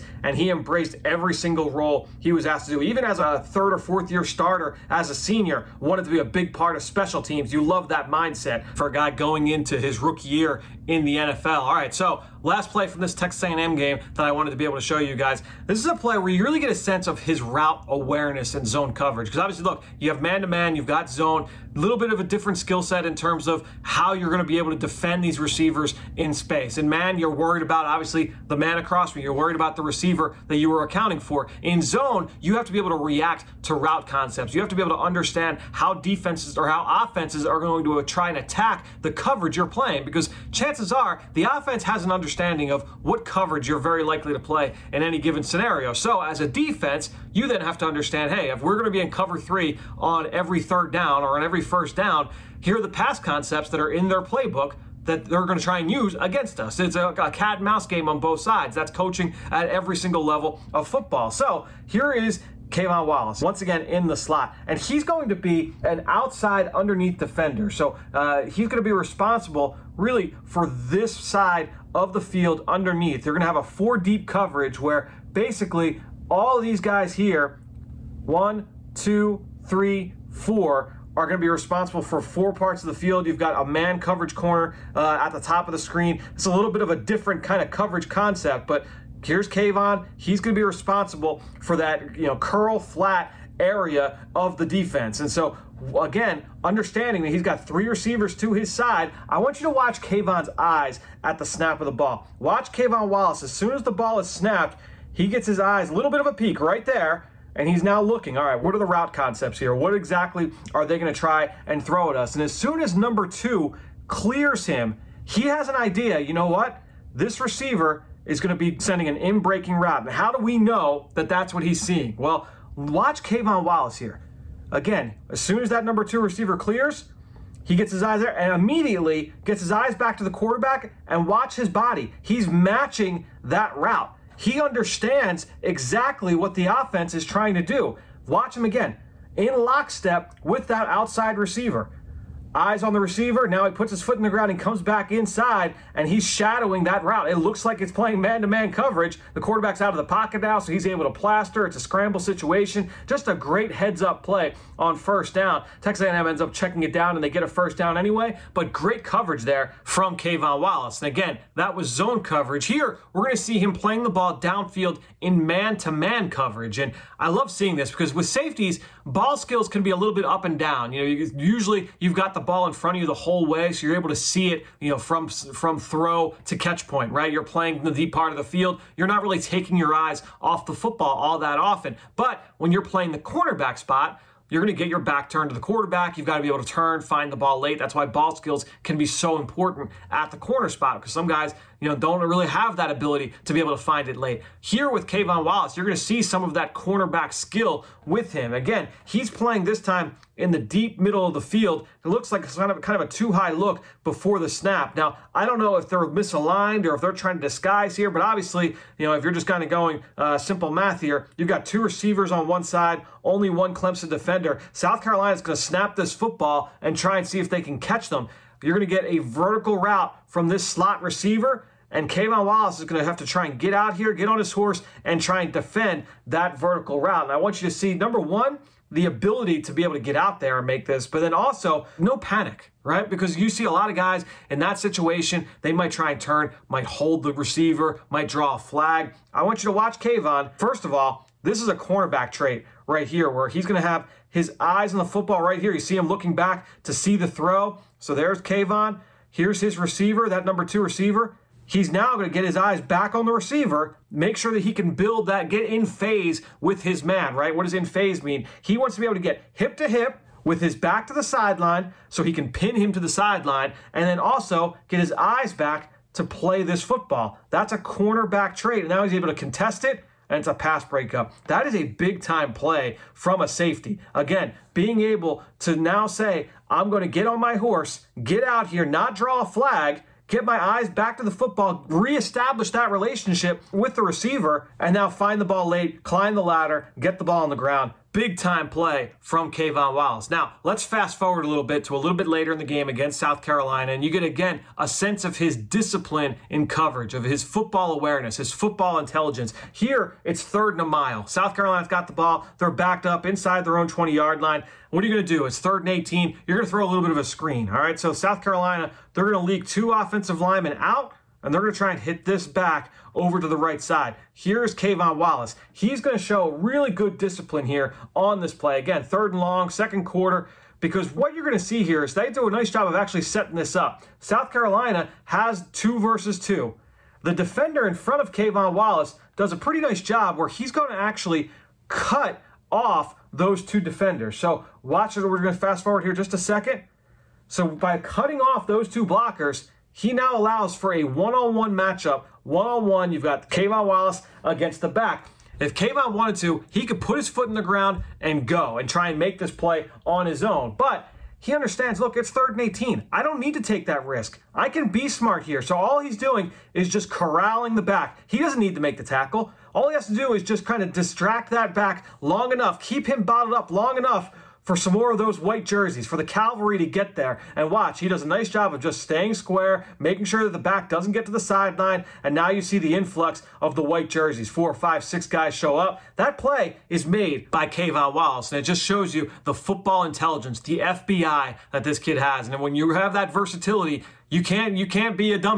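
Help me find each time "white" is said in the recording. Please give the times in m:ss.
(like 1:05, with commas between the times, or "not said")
6:05, 6:13.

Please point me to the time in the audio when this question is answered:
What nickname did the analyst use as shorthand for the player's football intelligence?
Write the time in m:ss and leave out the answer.
6:20.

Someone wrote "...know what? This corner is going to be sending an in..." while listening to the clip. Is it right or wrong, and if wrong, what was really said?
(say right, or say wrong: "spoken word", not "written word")
wrong: "receiver", not "corner".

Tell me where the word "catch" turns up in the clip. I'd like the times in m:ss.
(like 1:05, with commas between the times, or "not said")
2:56, 3:37.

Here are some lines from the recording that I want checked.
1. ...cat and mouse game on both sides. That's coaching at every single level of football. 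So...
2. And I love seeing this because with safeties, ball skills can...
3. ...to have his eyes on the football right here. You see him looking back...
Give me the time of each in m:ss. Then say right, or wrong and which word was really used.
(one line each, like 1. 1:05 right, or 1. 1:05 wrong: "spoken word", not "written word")
1. 0:57 right
2. 2:46 right
3. 4:03 right.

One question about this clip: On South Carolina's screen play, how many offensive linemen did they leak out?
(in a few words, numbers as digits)
2.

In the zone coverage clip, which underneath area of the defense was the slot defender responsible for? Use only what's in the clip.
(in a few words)
curl flat area.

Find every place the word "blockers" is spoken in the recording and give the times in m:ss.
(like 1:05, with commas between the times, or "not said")
5:39.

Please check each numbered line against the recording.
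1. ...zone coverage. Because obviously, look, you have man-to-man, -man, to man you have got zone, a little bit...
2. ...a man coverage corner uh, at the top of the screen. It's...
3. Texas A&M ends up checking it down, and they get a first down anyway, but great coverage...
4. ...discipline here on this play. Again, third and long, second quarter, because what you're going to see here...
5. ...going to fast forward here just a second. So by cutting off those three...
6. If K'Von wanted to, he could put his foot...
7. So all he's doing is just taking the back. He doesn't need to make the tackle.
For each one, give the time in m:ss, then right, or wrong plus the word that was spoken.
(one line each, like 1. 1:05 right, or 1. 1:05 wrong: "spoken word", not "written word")
1. 0:18 right
2. 1:23 right
3. 2:35 right
4. 5:17 right
5. 5:35 wrong: "two", not "three"
6. 5:45 right
7. 5:55 wrong: "corralling", not "taking".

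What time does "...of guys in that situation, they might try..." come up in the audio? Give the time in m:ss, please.
3:53.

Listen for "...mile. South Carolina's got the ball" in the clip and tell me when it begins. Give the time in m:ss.
5:00.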